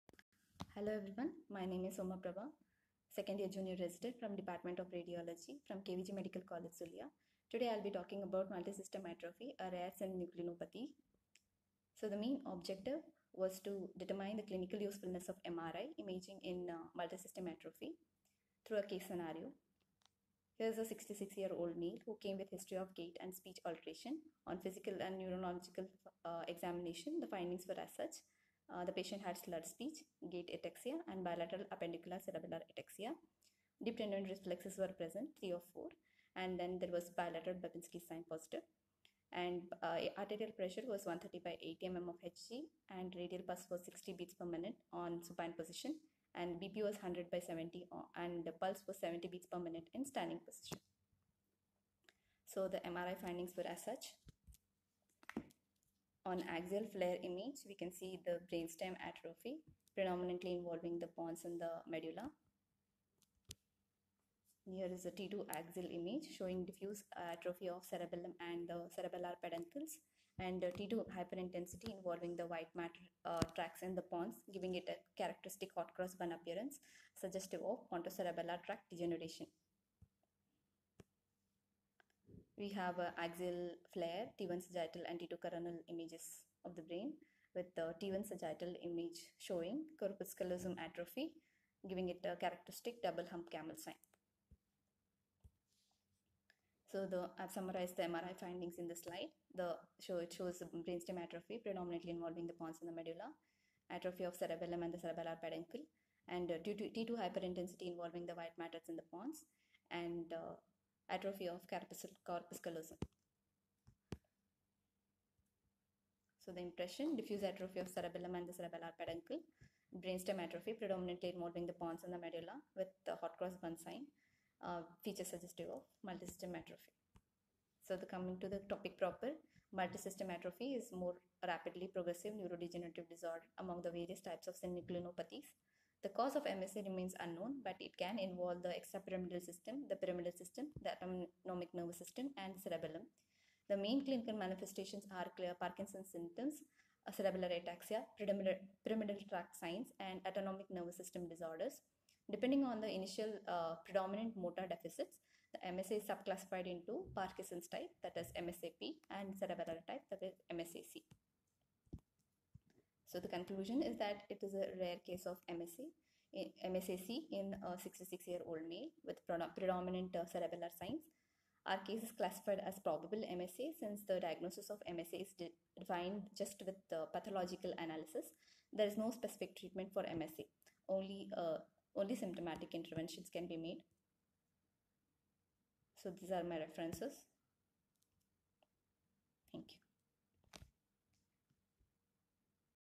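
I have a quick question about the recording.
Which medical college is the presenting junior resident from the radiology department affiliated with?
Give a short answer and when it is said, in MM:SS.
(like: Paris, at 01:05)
KVG Medical College, at 00:05.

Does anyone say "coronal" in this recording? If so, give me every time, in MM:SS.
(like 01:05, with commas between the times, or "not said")
01:25.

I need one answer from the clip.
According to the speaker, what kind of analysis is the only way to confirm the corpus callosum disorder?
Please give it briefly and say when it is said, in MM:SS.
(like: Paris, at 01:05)
pathological analysis, at 02:57.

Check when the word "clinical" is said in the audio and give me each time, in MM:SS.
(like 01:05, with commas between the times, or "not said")
00:14, 02:24.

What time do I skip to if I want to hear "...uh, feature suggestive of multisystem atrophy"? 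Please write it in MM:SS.
02:04.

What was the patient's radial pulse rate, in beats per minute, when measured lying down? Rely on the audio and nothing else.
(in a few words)
60.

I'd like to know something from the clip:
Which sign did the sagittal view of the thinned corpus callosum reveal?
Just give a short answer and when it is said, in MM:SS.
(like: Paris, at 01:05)
double hump camel sign, at 01:33.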